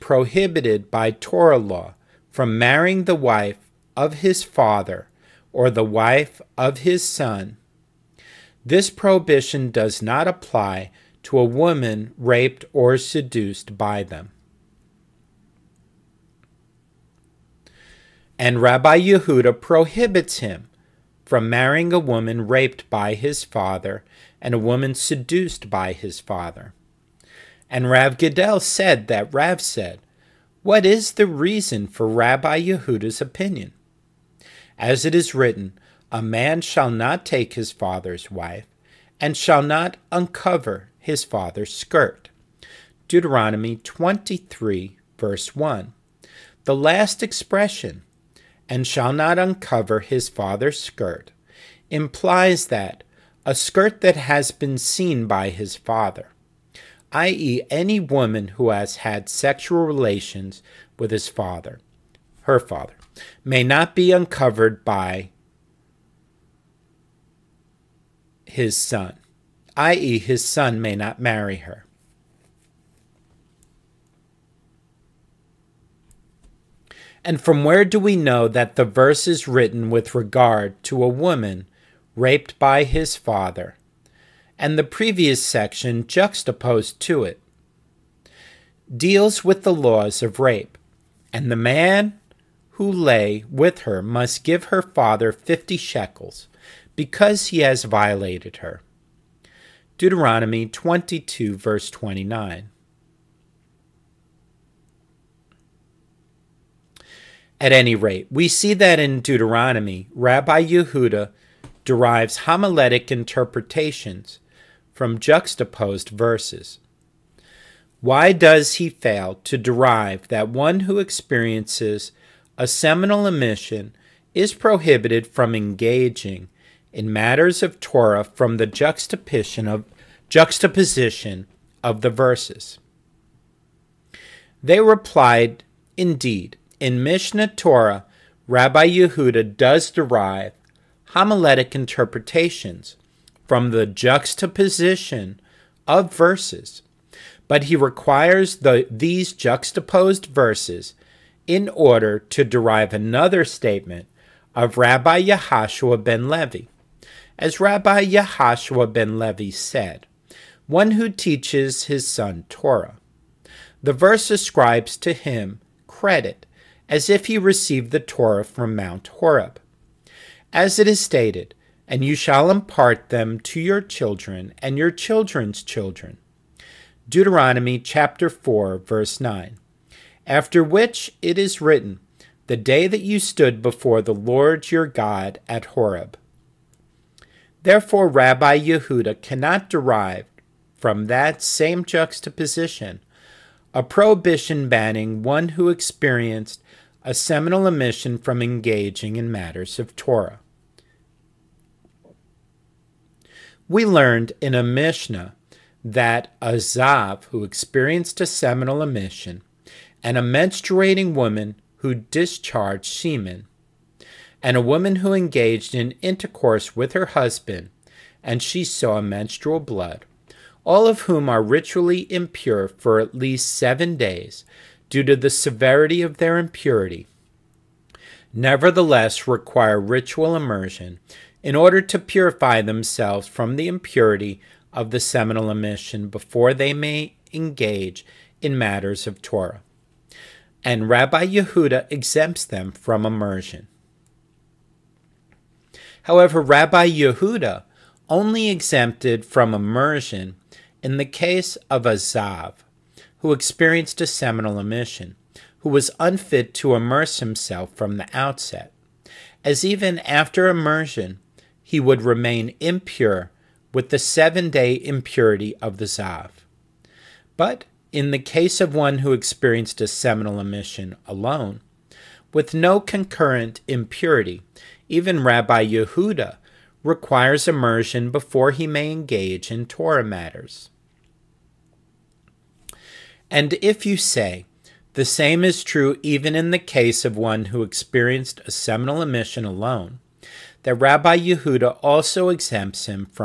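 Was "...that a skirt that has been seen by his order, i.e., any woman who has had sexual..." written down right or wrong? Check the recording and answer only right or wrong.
wrong.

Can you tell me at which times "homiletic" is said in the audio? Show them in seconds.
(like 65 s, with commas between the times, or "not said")
112 s, 141 s.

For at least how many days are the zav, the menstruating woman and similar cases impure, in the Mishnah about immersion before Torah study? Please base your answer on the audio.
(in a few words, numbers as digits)
7.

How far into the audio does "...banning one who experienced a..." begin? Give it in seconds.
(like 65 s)
194 s.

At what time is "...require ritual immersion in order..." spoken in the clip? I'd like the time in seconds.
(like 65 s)
229 s.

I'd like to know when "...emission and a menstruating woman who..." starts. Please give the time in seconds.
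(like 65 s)
208 s.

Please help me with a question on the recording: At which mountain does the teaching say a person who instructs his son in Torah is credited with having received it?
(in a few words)
Mount Horeb.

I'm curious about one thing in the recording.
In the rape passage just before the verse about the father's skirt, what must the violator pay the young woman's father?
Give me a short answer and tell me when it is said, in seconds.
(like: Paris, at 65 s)
50 shekels, at 95 s.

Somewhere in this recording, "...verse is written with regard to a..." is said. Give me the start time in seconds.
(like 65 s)
78 s.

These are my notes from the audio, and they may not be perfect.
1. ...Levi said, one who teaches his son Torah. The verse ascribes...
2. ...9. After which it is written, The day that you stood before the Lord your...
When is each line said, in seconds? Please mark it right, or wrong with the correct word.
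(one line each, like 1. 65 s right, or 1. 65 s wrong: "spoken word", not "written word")
1. 159 s right
2. 179 s right.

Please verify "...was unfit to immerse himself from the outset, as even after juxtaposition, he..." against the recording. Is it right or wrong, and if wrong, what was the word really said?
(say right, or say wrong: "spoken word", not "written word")
wrong: "immersion", not "juxtaposition".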